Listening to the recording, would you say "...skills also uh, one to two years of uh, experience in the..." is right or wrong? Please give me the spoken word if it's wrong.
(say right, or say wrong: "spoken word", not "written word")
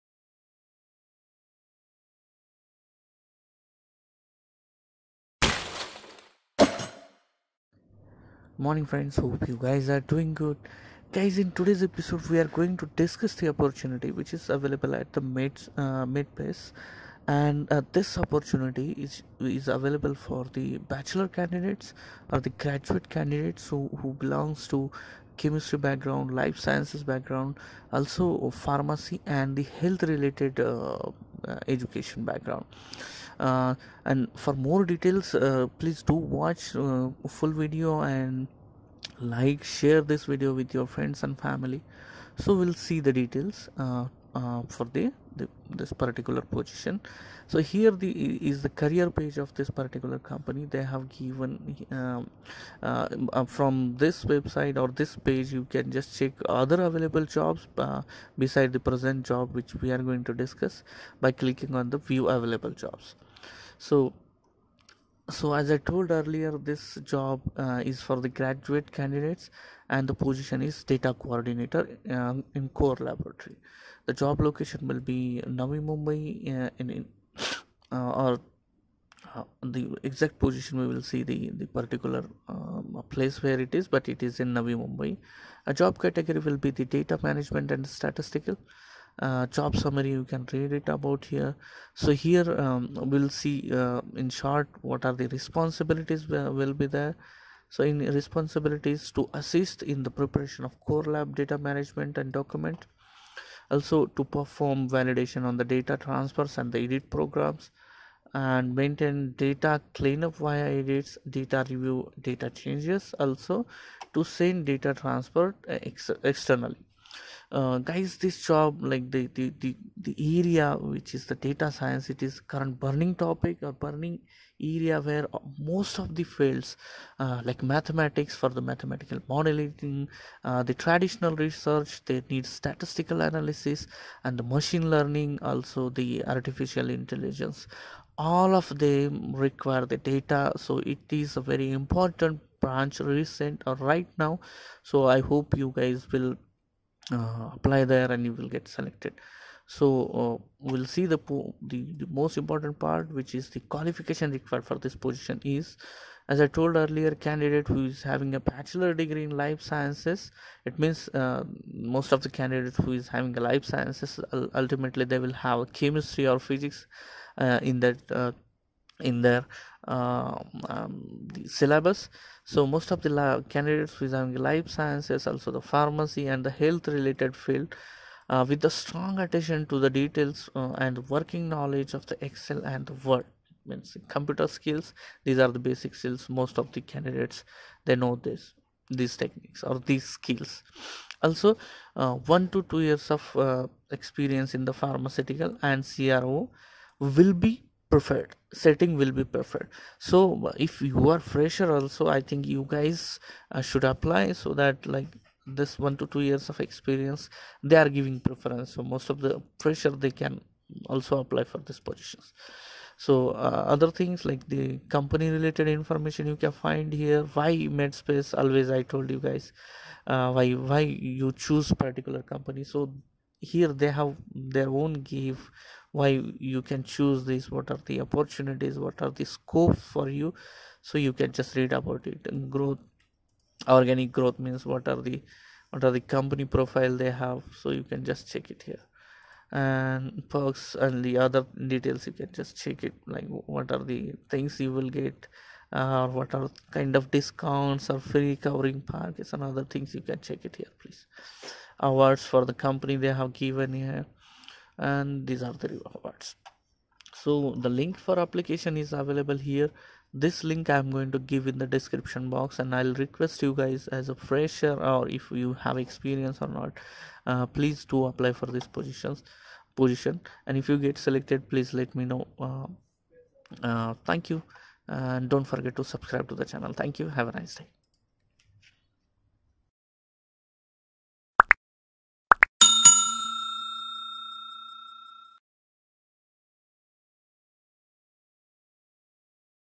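right.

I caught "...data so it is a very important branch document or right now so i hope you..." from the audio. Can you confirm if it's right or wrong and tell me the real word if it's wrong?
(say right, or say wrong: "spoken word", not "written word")
wrong: "recent", not "document".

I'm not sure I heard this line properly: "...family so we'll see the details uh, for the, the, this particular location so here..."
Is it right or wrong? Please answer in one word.
wrong.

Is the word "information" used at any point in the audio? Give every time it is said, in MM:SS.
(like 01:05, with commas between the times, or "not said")
03:35.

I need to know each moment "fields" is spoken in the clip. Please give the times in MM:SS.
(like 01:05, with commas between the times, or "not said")
02:06, 02:57.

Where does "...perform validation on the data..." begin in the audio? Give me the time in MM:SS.
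01:44.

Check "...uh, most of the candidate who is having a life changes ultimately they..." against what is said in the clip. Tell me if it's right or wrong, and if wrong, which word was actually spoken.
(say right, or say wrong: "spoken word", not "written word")
wrong: "sciences", not "changes".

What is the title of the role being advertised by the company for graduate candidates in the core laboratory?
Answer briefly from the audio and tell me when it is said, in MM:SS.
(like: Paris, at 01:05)
Data coordinator, at 01:10.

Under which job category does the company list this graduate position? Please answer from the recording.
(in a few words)
Data management and statistical.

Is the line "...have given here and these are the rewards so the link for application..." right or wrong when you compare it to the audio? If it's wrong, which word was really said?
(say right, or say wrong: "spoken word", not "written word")
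right.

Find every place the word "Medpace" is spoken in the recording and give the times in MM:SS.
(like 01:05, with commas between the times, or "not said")
00:16, 03:37.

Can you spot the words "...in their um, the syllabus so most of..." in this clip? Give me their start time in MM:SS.
02:48.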